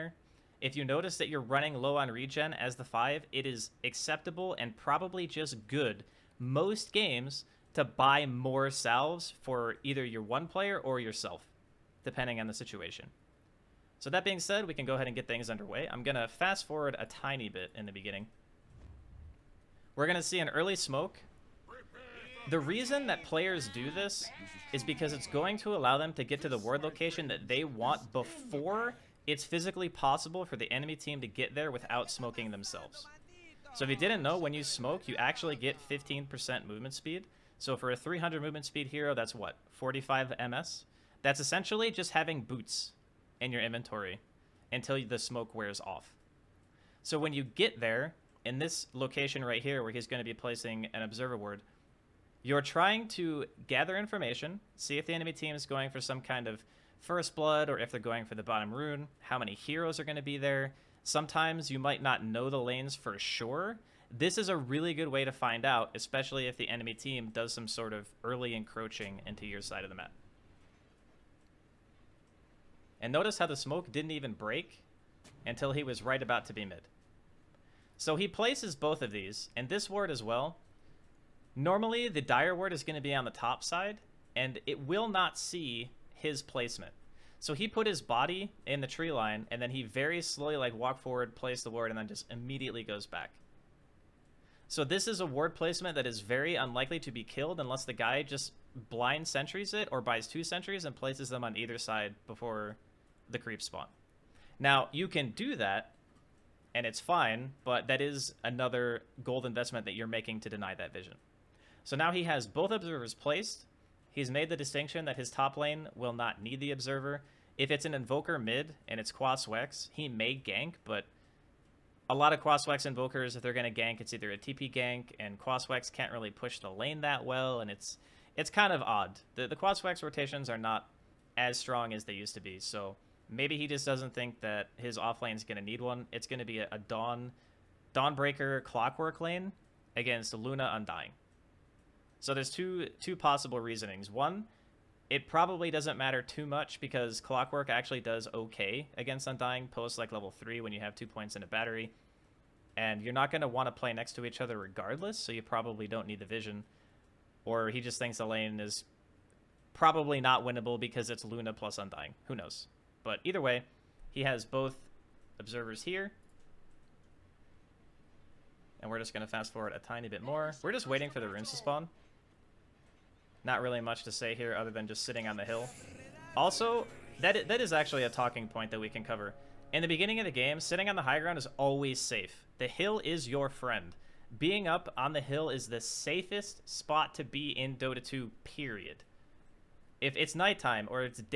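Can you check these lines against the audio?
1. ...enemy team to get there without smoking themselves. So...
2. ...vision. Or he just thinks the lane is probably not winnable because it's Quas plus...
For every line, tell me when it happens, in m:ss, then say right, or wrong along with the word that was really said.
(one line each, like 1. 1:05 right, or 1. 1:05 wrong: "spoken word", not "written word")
1. 0:30 right
2. 2:36 wrong: "Luna", not "Quas".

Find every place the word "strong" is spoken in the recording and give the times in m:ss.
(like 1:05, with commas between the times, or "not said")
2:11.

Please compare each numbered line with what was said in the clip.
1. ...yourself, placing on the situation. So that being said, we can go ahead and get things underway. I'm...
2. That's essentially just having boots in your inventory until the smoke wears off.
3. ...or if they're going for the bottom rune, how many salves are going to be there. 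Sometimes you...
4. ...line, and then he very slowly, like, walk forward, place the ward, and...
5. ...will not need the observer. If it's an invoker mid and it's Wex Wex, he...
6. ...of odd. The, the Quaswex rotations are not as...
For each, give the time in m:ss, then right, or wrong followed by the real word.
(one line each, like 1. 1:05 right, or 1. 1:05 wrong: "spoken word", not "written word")
1. 0:11 wrong: "depending", not "placing"
2. 0:41 right
3. 0:57 wrong: "heroes", not "salves"
4. 1:29 right
5. 1:55 wrong: "Quas", not "Wex"
6. 2:08 right.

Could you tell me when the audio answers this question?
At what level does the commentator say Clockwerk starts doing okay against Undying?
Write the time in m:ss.
2:30.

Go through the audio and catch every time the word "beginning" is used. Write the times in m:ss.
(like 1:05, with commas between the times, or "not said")
0:17, 2:59.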